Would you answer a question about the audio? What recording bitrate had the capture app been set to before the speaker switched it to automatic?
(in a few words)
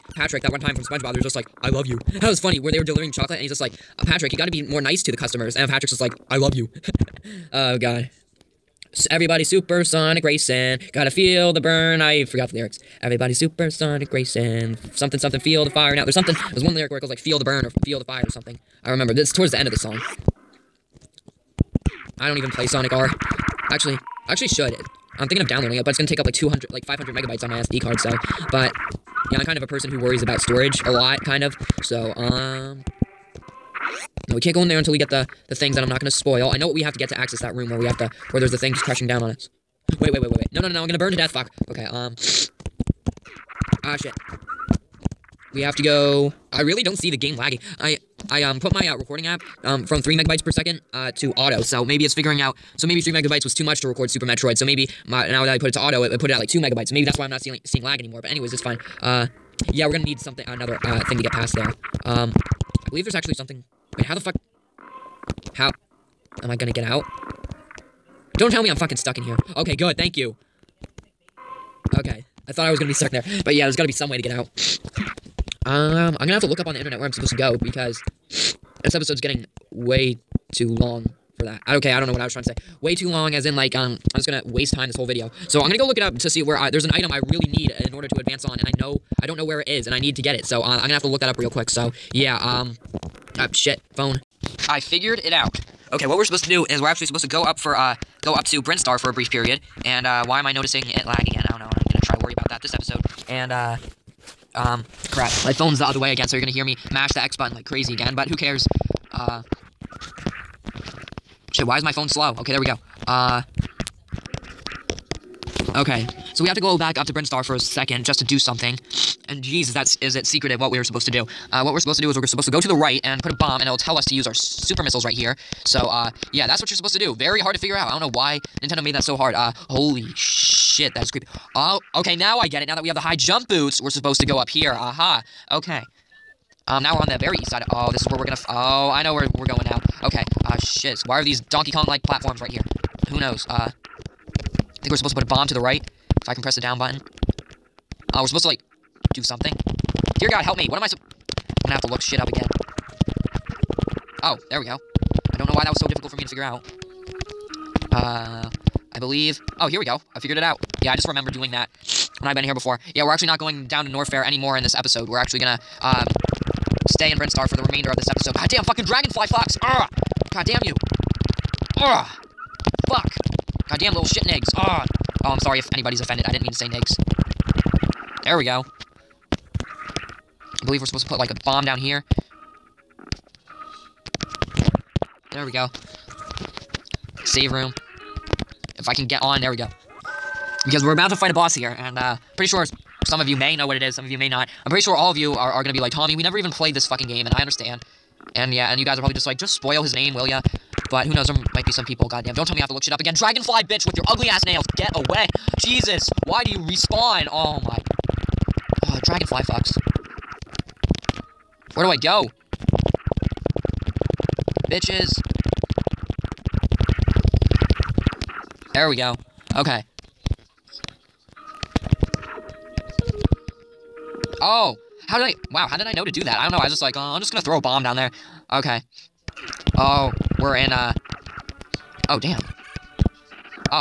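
3 megabytes per second.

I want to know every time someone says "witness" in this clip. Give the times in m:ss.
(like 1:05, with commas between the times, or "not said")
not said.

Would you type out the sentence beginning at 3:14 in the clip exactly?
I'm pretty sure all of you are, are gonna be like, Tommy, we never even played this fucking game, and I understand.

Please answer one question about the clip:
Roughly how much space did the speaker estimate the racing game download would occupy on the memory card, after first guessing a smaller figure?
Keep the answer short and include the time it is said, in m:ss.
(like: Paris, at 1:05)
500 megabytes, at 0:26.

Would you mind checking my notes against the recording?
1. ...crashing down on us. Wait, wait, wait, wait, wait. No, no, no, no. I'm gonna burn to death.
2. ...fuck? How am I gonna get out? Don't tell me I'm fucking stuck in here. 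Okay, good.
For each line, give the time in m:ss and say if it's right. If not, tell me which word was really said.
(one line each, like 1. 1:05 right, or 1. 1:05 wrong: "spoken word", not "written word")
1. 0:38 right
2. 1:04 right.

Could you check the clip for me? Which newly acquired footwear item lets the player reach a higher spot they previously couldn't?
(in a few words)
high jump boots.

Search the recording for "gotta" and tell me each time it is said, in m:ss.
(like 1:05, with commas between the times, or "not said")
0:04, 0:10, 1:13.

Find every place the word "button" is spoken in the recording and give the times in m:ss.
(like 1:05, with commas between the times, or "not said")
1:47, 2:26.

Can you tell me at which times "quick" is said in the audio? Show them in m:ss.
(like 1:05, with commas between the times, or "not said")
1:31.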